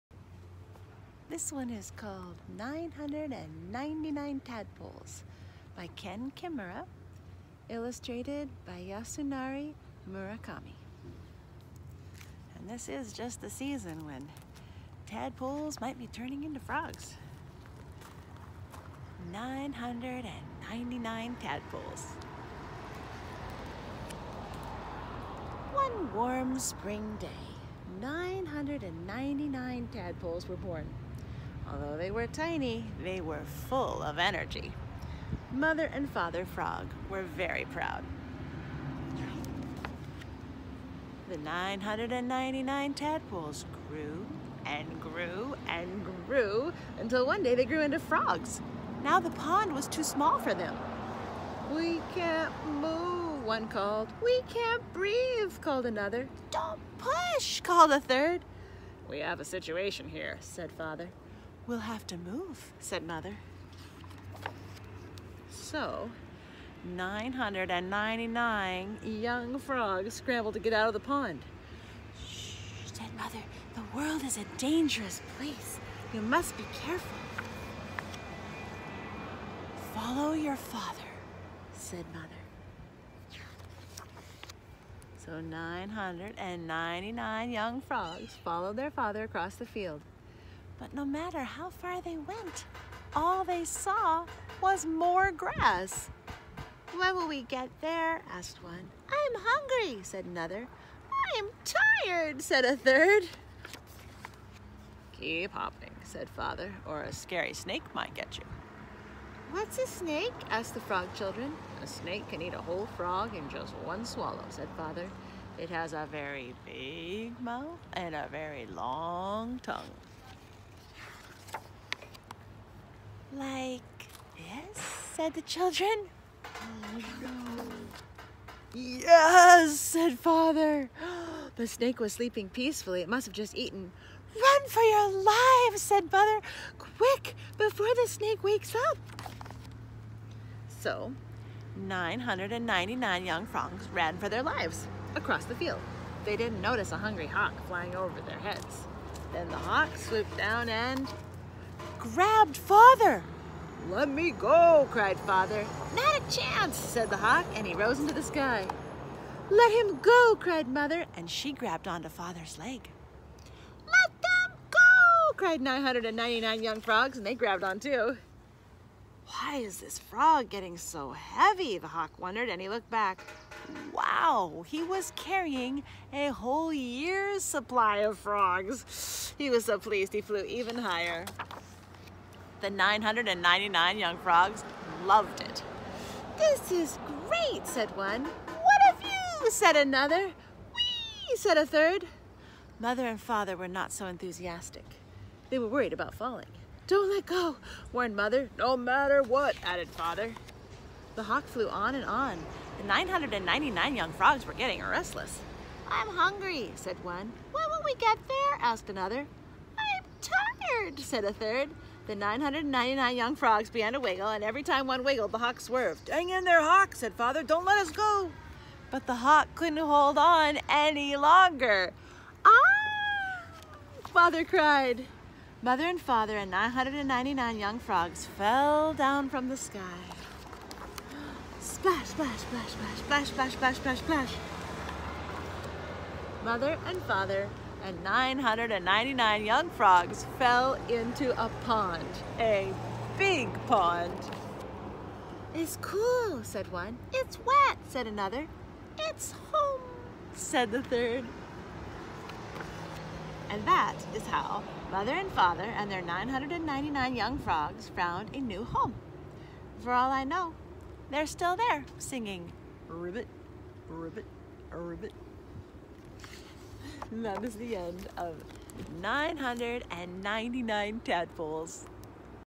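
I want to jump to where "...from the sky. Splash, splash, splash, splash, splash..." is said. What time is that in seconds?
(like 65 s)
229 s.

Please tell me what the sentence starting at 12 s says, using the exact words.
And this is just the season when tadpoles might be turning into frogs.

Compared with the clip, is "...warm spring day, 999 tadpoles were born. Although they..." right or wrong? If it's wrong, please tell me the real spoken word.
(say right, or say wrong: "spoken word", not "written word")
right.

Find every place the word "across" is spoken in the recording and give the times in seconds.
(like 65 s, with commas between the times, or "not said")
89 s, 145 s.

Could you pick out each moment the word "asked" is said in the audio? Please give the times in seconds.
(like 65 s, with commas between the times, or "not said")
98 s, 110 s, 208 s.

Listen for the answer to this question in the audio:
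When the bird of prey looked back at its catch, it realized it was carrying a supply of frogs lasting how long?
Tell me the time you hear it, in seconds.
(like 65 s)
176 s.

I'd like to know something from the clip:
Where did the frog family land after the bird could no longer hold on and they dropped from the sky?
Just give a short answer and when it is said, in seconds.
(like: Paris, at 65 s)
A big pond, at 242 s.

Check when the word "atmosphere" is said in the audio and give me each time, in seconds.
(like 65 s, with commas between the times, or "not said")
not said.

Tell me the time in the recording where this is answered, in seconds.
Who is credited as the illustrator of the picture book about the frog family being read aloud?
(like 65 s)
8 s.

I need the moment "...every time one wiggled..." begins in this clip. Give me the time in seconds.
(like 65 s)
214 s.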